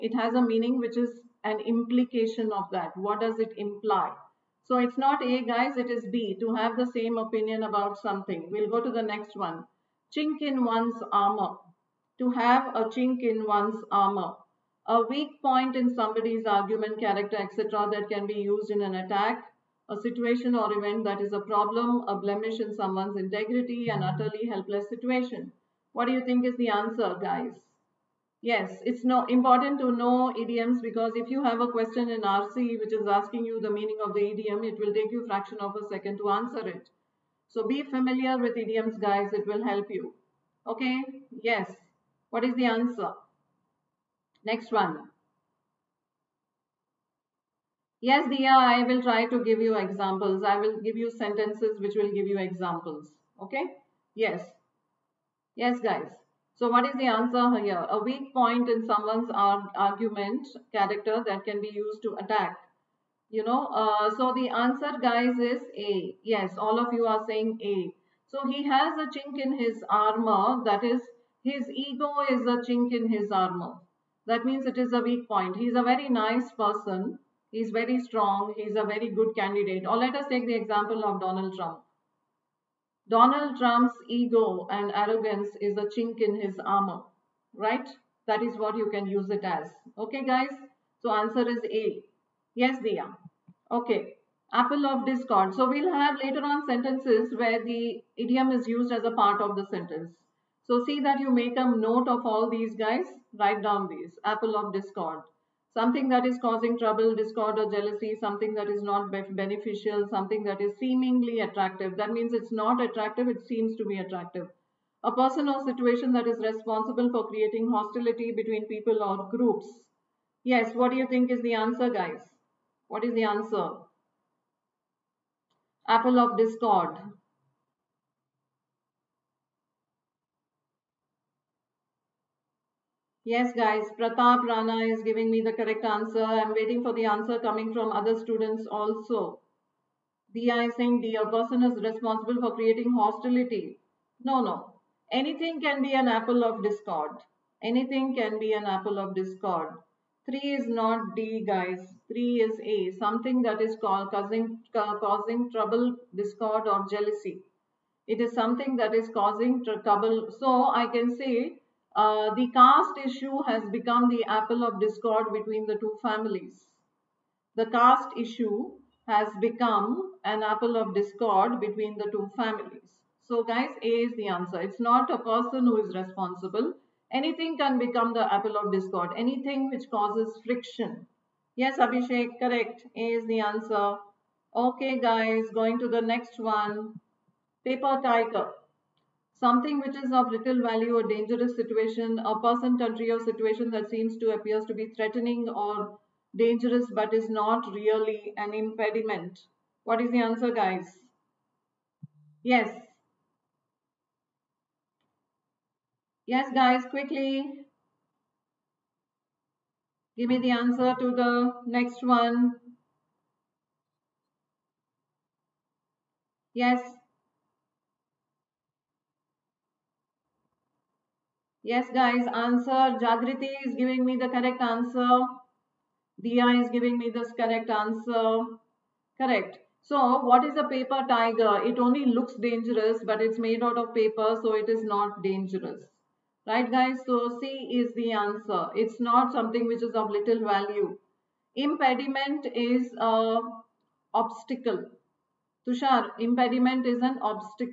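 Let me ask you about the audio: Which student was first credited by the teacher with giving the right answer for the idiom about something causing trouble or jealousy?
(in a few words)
Pratap Rana.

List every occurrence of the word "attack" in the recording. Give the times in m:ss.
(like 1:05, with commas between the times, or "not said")
0:18, 1:02.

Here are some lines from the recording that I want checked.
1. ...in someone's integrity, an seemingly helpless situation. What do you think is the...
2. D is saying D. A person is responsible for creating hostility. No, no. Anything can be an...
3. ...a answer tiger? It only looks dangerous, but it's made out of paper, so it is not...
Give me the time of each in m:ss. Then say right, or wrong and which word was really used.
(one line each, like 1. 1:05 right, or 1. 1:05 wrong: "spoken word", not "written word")
1. 0:22 wrong: "utterly", not "seemingly"
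2. 2:20 right
3. 3:50 wrong: "paper", not "answer".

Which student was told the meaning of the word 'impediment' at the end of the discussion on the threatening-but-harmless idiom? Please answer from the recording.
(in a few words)
Tushar.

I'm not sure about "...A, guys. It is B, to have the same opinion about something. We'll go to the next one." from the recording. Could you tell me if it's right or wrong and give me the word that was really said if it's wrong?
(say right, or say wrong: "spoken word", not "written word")
right.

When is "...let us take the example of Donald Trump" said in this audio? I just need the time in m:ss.
1:19.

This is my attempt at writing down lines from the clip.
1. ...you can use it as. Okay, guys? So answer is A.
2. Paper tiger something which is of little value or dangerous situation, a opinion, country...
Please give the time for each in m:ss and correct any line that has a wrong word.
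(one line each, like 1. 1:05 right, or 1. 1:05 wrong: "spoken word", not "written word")
1. 1:28 right
2. 3:07 wrong: "person", not "opinion".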